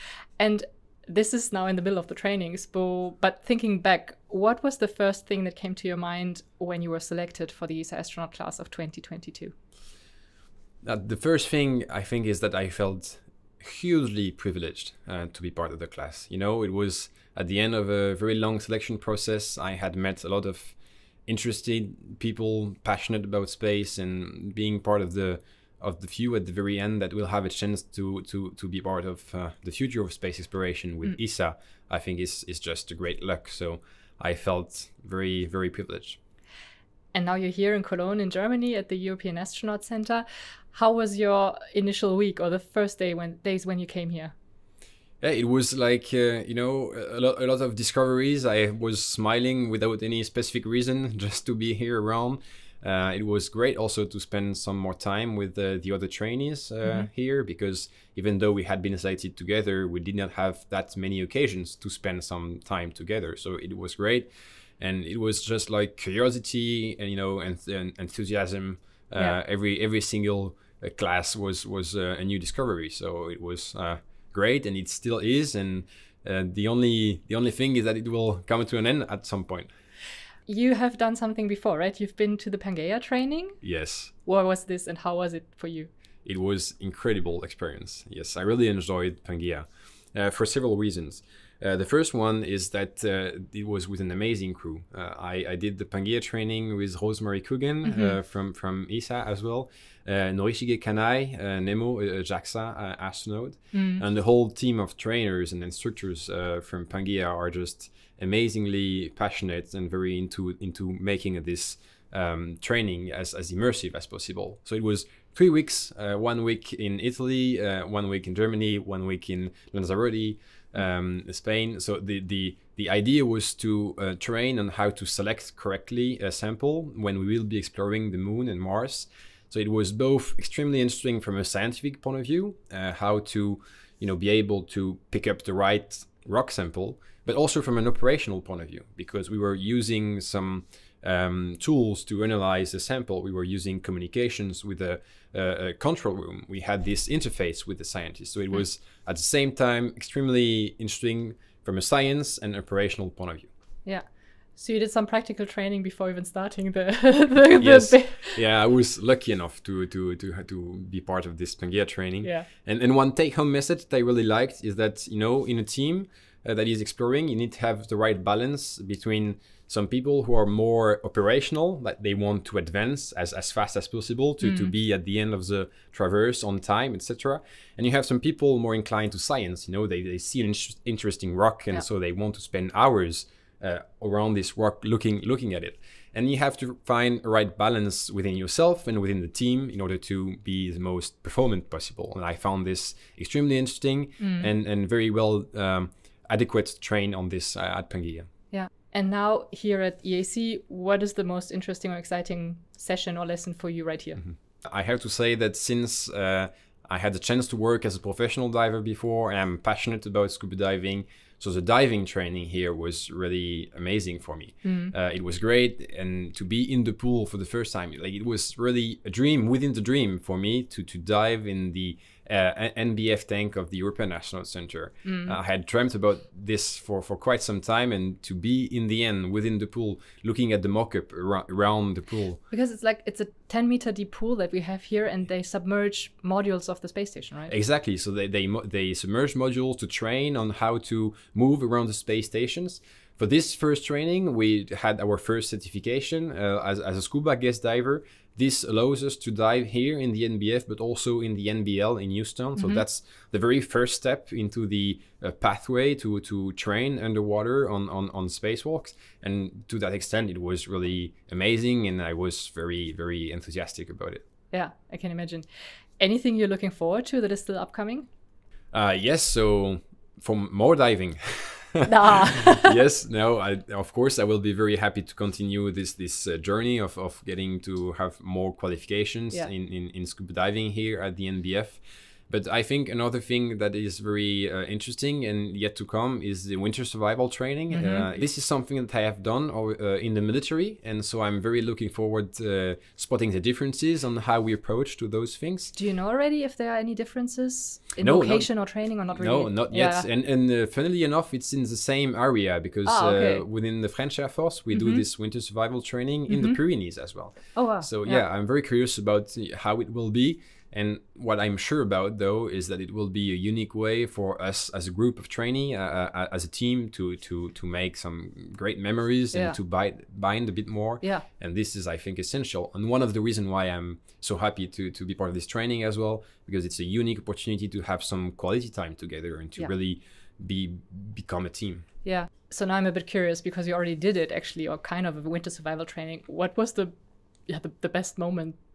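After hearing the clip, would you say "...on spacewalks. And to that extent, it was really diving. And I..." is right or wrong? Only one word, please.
wrong.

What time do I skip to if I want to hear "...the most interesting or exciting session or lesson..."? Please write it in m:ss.
3:21.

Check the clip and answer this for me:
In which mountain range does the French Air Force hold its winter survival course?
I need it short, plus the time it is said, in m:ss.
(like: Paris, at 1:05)
Pyrenees, at 5:06.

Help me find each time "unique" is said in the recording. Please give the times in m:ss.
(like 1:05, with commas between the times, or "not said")
5:13, 5:27.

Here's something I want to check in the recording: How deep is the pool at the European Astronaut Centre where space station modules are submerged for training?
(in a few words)
10 meters.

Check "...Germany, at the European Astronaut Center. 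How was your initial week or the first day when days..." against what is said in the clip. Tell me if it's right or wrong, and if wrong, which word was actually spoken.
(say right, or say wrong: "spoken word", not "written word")
right.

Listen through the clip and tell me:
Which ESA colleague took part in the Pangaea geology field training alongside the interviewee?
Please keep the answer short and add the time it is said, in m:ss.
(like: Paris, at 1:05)
Rosemary Coogan, at 1:37.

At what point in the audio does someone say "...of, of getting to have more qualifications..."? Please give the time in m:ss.
4:36.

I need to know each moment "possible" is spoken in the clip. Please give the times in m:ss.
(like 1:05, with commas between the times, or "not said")
1:54, 2:53, 3:11.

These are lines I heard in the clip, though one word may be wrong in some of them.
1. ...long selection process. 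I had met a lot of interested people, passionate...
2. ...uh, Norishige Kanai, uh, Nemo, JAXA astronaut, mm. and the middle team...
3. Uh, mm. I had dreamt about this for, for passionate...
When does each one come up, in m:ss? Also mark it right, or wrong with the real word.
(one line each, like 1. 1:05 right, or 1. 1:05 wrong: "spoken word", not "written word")
1. 0:18 right
2. 1:40 wrong: "whole", not "middle"
3. 3:45 wrong: "quite", not "passionate".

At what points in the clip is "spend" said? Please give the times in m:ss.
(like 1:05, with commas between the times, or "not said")
0:54, 1:01, 3:02.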